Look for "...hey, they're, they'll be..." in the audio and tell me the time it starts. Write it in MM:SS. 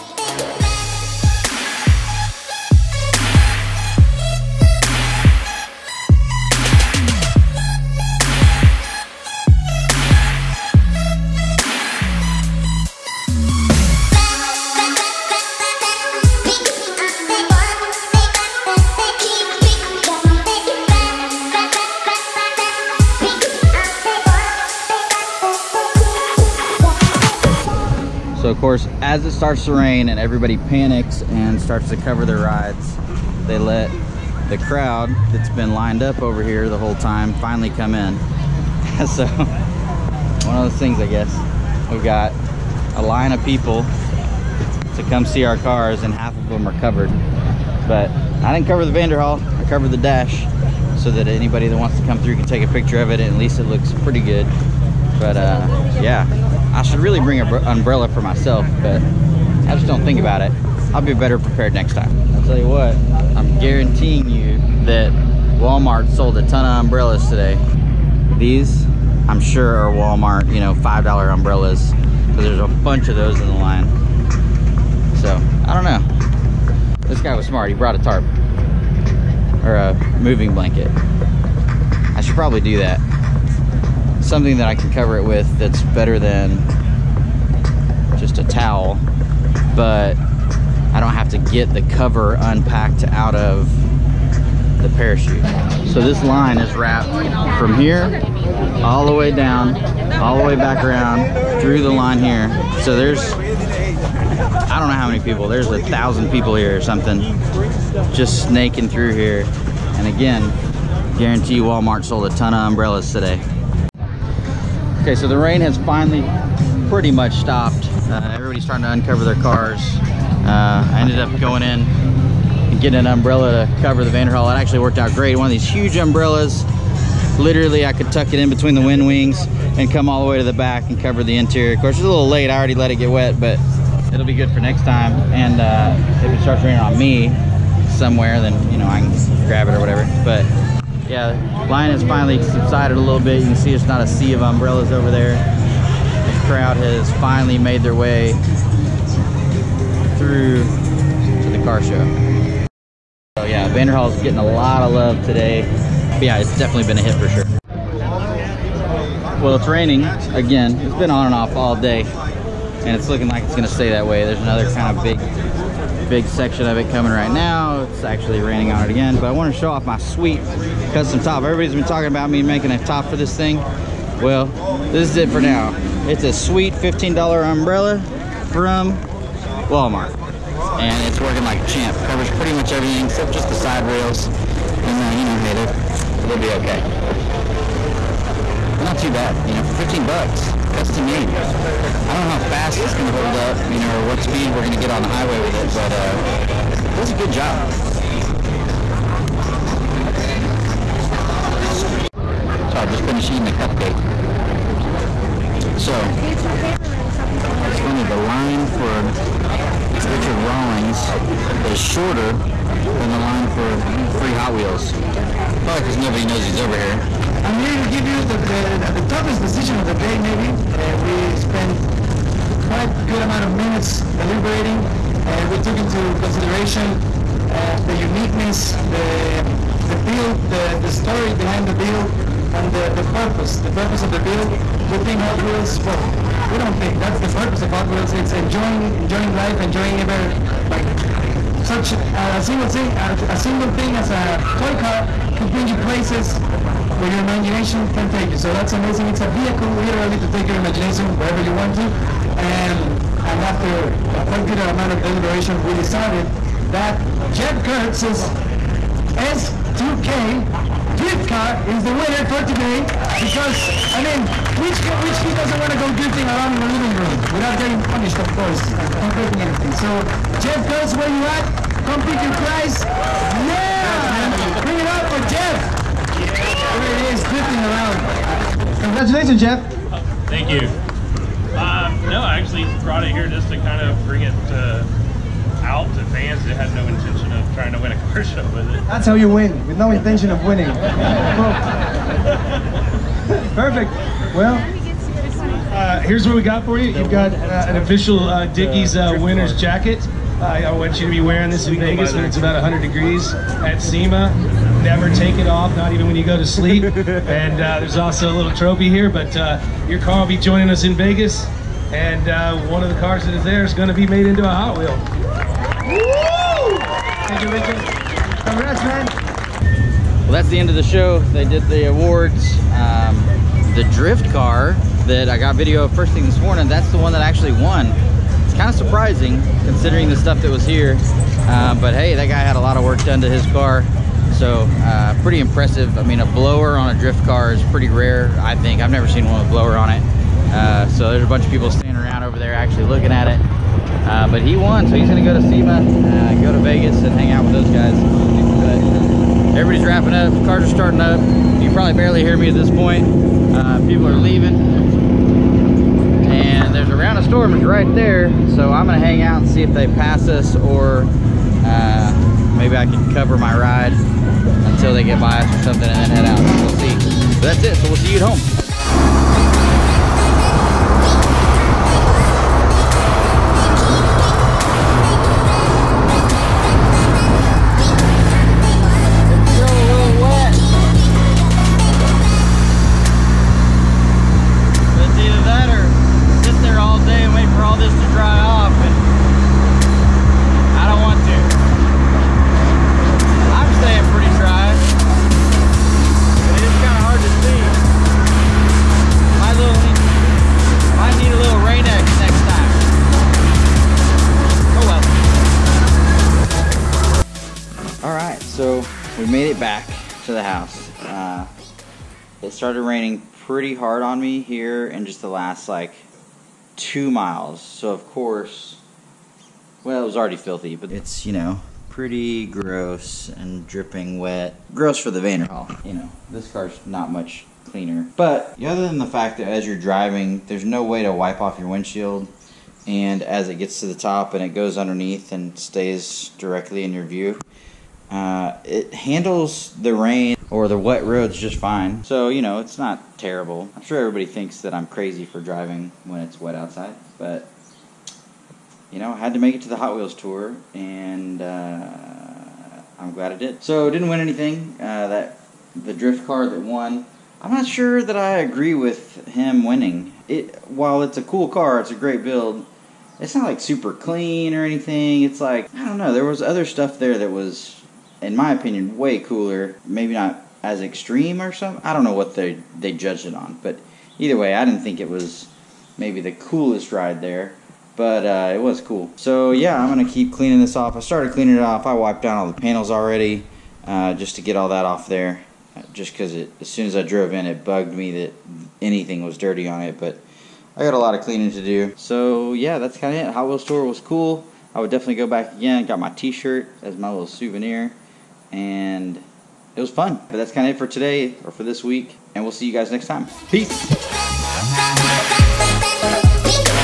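03:05.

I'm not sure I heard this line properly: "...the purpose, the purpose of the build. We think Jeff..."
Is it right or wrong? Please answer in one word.
wrong.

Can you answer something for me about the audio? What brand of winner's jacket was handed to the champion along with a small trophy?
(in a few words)
Dickies.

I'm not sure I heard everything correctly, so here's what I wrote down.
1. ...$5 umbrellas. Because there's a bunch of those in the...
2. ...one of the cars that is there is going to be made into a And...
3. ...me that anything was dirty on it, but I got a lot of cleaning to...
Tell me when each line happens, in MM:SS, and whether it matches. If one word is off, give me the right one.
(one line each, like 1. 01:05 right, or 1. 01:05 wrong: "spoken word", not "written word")
1. 01:10 right
2. 05:12 wrong: "Hot", not "And"
3. 08:07 right.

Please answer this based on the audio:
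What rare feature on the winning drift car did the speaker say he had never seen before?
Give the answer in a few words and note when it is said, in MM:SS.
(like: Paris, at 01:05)
A blower, at 05:36.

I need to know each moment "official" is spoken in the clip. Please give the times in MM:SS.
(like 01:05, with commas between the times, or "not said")
04:57.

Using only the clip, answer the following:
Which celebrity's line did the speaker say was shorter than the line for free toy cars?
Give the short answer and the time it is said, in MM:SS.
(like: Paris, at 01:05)
Richard Rawlings, at 03:30.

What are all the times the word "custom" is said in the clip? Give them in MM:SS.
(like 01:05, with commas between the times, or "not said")
02:50, 03:10.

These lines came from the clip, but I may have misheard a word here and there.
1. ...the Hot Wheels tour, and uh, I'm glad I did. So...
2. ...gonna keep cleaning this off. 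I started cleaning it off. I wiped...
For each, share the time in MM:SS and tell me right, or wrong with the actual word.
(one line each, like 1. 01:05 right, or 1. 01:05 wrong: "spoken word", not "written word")
1. 07:29 right
2. 07:59 right.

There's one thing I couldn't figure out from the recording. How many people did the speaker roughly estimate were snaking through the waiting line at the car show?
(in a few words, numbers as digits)
1,000.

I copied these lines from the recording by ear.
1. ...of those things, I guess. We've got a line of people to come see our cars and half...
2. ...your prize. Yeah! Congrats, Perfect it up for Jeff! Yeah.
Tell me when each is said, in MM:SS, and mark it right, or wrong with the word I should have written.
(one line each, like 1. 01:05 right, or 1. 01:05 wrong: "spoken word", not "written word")
1. 00:40 right
2. 04:32 wrong: "Bring", not "Perfect".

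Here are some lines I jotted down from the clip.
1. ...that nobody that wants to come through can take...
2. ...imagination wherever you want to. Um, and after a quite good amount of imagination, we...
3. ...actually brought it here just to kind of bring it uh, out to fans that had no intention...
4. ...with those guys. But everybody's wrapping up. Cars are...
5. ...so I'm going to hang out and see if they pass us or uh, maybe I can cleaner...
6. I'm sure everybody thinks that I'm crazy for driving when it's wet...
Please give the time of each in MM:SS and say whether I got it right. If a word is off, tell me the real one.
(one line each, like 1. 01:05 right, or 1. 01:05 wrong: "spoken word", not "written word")
1. 00:51 wrong: "anybody", not "nobody"
2. 04:10 wrong: "deliberation", not "imagination"
3. 04:42 right
4. 05:47 right
5. 05:58 wrong: "cover", not "cleaner"
6. 07:23 right.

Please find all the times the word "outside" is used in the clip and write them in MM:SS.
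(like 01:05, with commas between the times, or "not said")
07:26.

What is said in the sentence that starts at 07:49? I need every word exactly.
Maybe not as extreme or something.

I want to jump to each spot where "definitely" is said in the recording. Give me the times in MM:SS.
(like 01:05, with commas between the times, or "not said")
02:36, 08:14.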